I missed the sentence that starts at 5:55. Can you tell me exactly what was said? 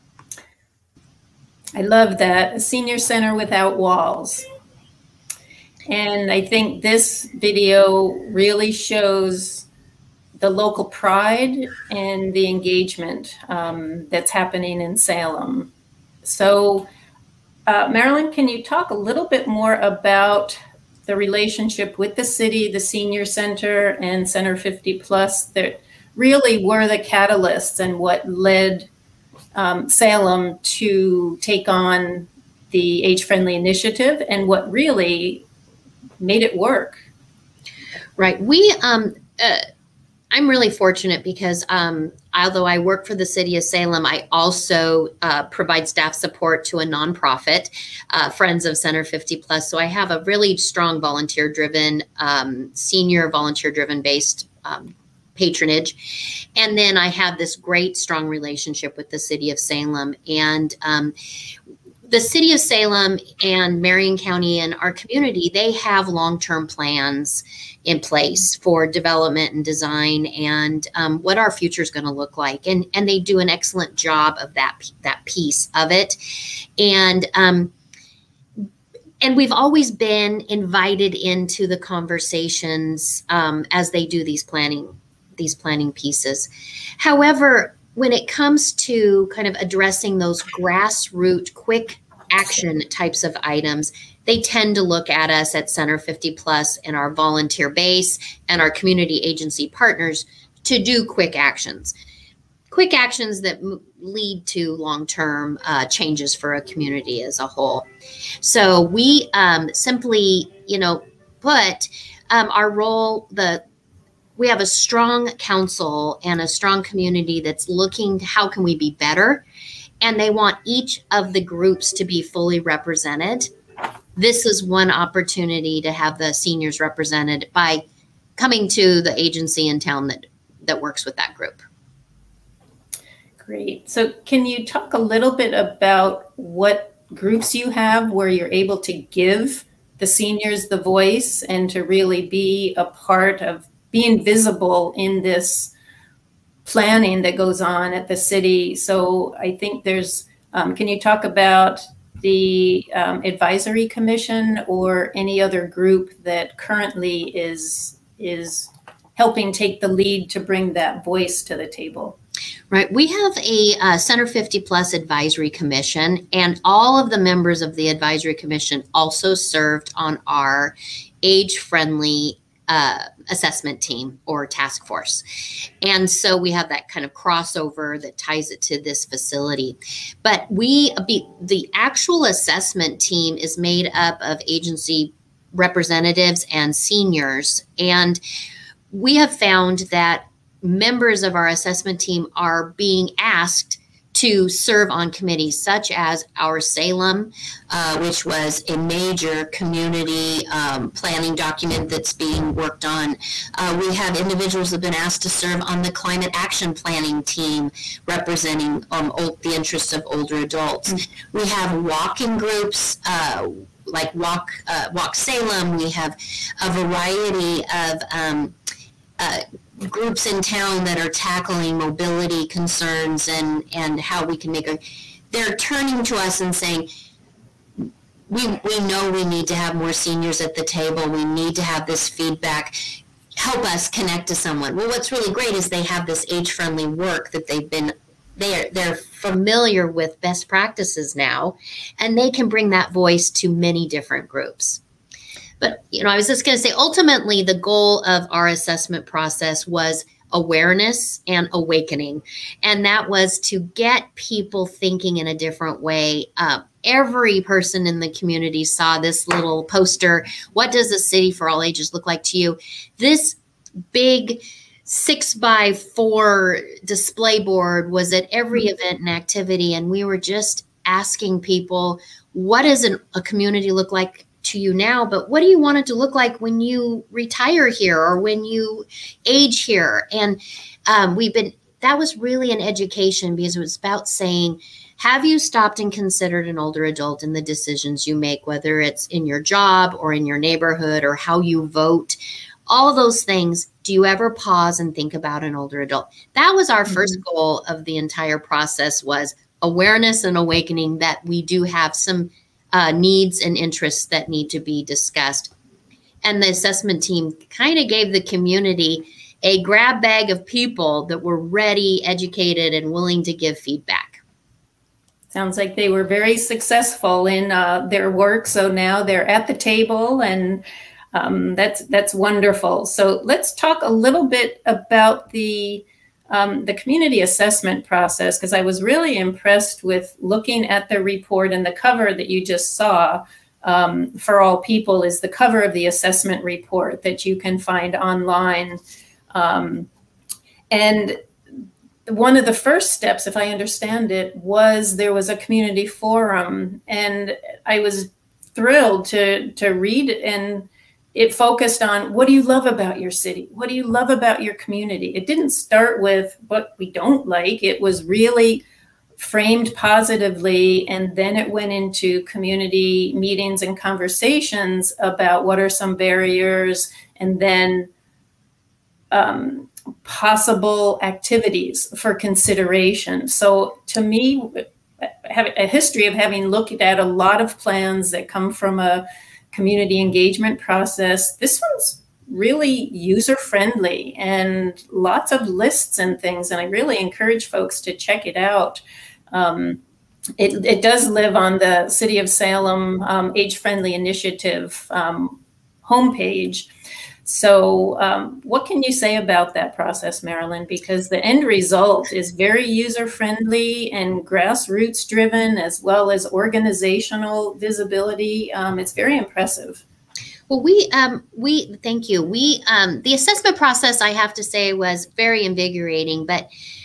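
It didn't start with what we don't like.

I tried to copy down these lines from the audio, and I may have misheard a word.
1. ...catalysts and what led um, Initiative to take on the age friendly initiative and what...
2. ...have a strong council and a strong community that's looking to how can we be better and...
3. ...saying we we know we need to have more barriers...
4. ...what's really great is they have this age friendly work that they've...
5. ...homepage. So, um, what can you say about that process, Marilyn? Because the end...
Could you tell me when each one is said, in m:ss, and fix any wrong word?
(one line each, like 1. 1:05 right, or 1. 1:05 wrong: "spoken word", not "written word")
1. 0:26 wrong: "Salem", not "Initiative"
2. 1:54 right
3. 3:46 wrong: "seniors", not "barriers"
4. 3:54 right
5. 6:35 right.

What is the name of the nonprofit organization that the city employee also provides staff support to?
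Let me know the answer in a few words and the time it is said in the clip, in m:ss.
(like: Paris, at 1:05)
Friends of Center 50 Plus, at 0:48.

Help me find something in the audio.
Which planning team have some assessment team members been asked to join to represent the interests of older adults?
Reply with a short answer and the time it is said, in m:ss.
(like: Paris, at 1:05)
climate action planning team, at 3:25.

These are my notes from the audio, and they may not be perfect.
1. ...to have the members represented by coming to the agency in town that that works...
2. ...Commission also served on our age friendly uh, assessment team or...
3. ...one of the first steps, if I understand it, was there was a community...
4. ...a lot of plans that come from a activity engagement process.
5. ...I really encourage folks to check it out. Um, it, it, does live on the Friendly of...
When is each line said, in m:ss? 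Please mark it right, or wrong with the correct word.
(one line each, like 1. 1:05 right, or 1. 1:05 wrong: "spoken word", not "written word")
1. 2:05 wrong: "seniors", not "members"
2. 2:48 right
3. 5:42 right
4. 6:16 wrong: "community", not "activity"
5. 6:26 wrong: "City", not "Friendly".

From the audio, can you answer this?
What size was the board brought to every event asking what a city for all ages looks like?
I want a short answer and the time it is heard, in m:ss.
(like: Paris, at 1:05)
6 by 4, at 4:24.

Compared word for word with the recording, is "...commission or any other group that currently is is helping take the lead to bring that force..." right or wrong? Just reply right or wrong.
wrong.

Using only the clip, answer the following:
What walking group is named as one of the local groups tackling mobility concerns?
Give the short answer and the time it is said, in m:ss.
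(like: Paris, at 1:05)
Walk Salem, at 3:34.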